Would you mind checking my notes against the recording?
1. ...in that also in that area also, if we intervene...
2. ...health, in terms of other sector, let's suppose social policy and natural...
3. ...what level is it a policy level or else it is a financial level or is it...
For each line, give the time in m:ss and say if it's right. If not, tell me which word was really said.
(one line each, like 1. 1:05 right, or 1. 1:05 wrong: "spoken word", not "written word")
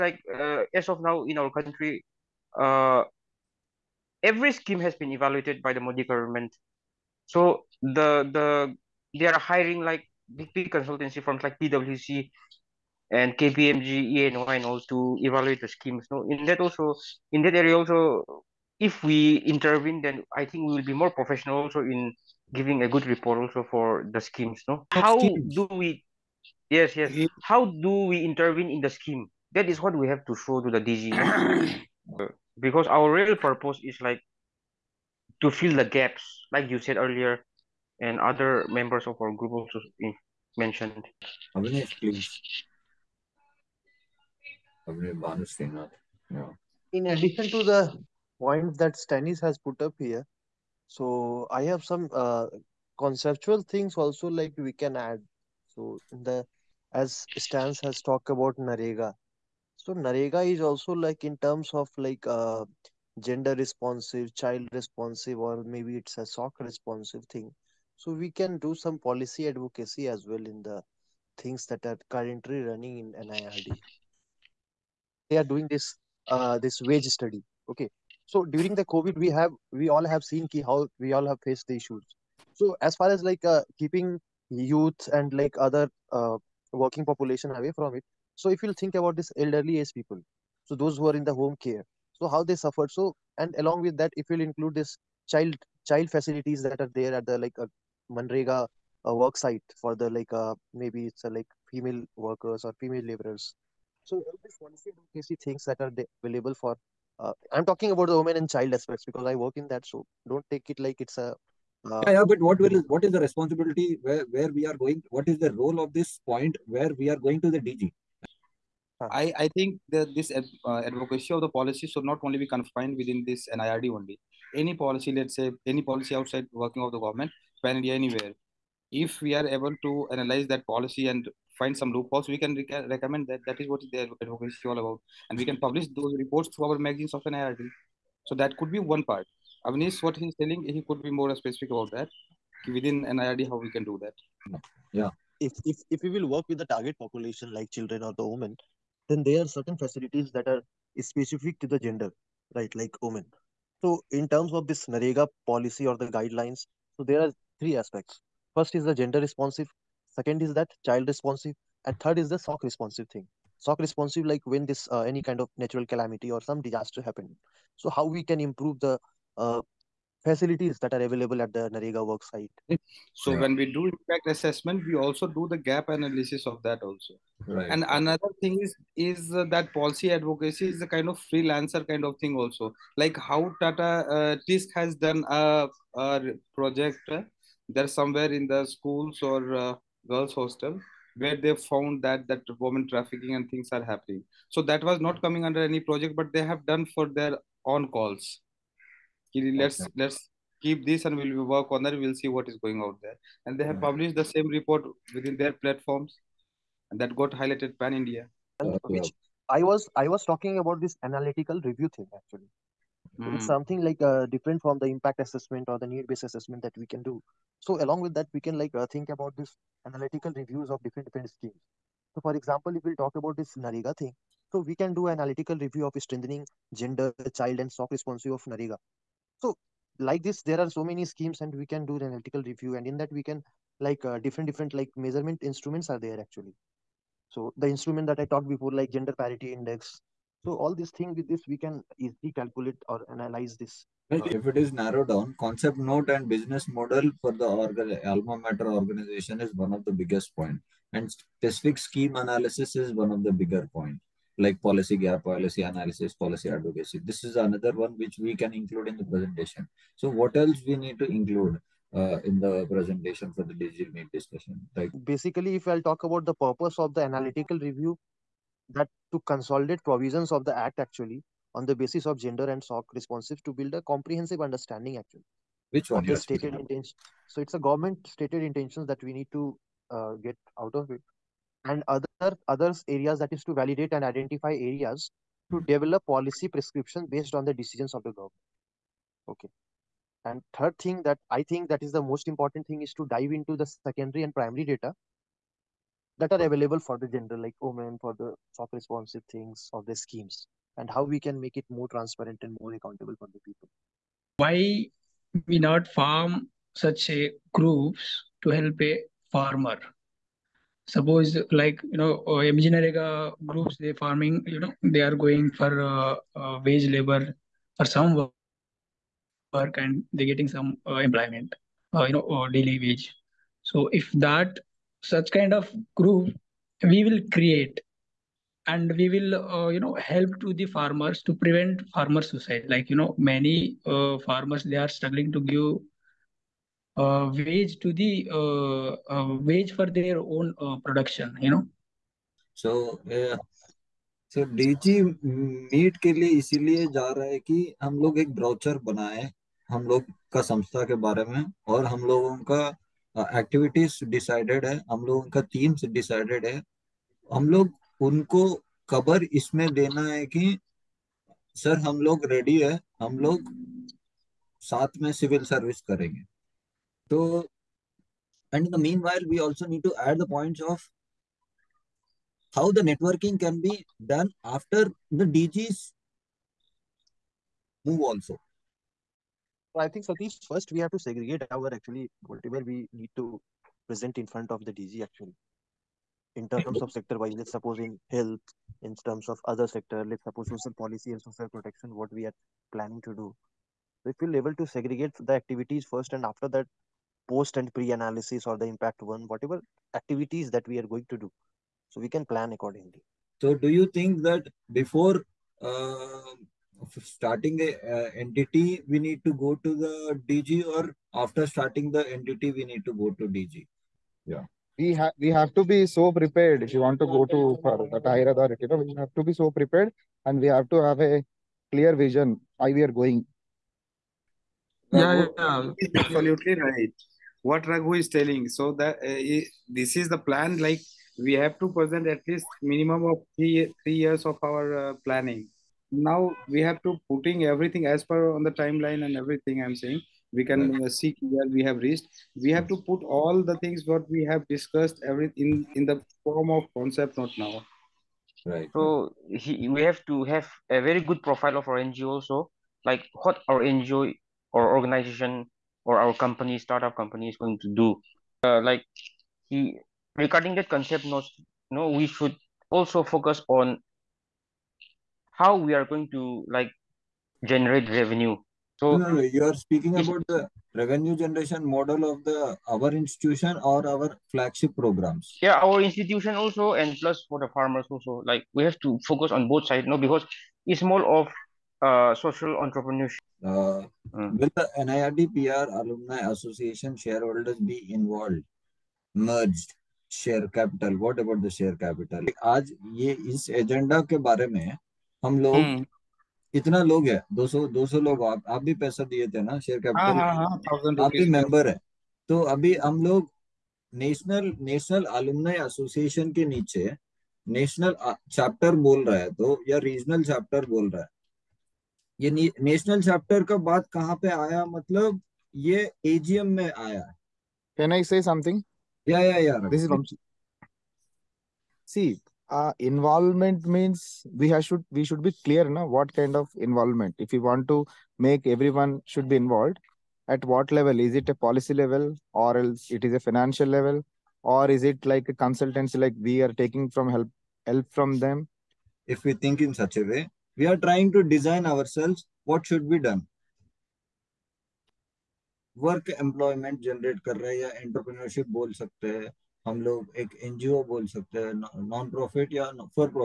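1. 0:16 right
2. 6:28 wrong: "social", not "natural"
3. 8:50 right.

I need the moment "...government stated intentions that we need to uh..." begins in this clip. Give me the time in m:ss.
4:37.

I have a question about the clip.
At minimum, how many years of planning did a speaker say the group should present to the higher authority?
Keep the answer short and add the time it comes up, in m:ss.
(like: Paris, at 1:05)
3 years, at 7:13.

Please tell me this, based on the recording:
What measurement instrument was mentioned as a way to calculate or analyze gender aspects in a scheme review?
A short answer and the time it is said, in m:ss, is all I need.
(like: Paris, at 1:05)
Gender parity index, at 3:58.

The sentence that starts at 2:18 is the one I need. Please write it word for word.
So that could be one part.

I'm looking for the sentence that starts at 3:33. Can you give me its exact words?
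It's something like uh, different from the impact assessment or the need-based assessment that we can do.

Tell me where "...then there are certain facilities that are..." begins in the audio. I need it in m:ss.
2:29.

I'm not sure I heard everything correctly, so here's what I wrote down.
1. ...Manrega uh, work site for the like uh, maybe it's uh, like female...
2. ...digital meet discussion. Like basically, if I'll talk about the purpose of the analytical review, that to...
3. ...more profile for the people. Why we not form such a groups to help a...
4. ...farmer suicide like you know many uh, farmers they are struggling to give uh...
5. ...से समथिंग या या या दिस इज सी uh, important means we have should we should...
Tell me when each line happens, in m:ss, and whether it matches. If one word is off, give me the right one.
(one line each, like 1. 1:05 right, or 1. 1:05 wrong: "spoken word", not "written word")
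1. 1:38 right
2. 4:23 right
3. 5:02 wrong: "accountable", not "profile"
4. 5:31 right
5. 8:38 wrong: "involvement", not "important".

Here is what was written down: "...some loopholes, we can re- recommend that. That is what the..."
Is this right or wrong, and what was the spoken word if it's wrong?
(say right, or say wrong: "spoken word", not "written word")
right.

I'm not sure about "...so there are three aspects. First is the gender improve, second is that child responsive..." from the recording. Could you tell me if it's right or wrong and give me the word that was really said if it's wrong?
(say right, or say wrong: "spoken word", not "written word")
wrong: "responsive", not "improve".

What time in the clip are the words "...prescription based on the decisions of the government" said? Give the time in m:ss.
4:46.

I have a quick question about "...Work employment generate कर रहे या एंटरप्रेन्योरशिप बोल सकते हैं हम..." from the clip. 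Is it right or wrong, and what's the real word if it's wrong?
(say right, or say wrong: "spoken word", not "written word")
right.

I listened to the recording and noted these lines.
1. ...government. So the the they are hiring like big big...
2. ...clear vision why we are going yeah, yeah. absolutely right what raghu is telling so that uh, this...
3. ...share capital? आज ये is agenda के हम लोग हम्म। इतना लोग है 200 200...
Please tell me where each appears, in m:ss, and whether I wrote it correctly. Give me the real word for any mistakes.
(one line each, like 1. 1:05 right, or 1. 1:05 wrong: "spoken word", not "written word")
1. 0:06 right
2. 7:01 right
3. 8:11 right.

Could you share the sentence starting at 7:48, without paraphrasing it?
So no, no, you are speaking about the revenue generation model of the our institution or our flagship programs.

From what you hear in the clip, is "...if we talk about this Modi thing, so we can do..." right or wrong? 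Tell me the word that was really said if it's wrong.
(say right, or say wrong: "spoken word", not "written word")
wrong: "Nariga", not "Modi".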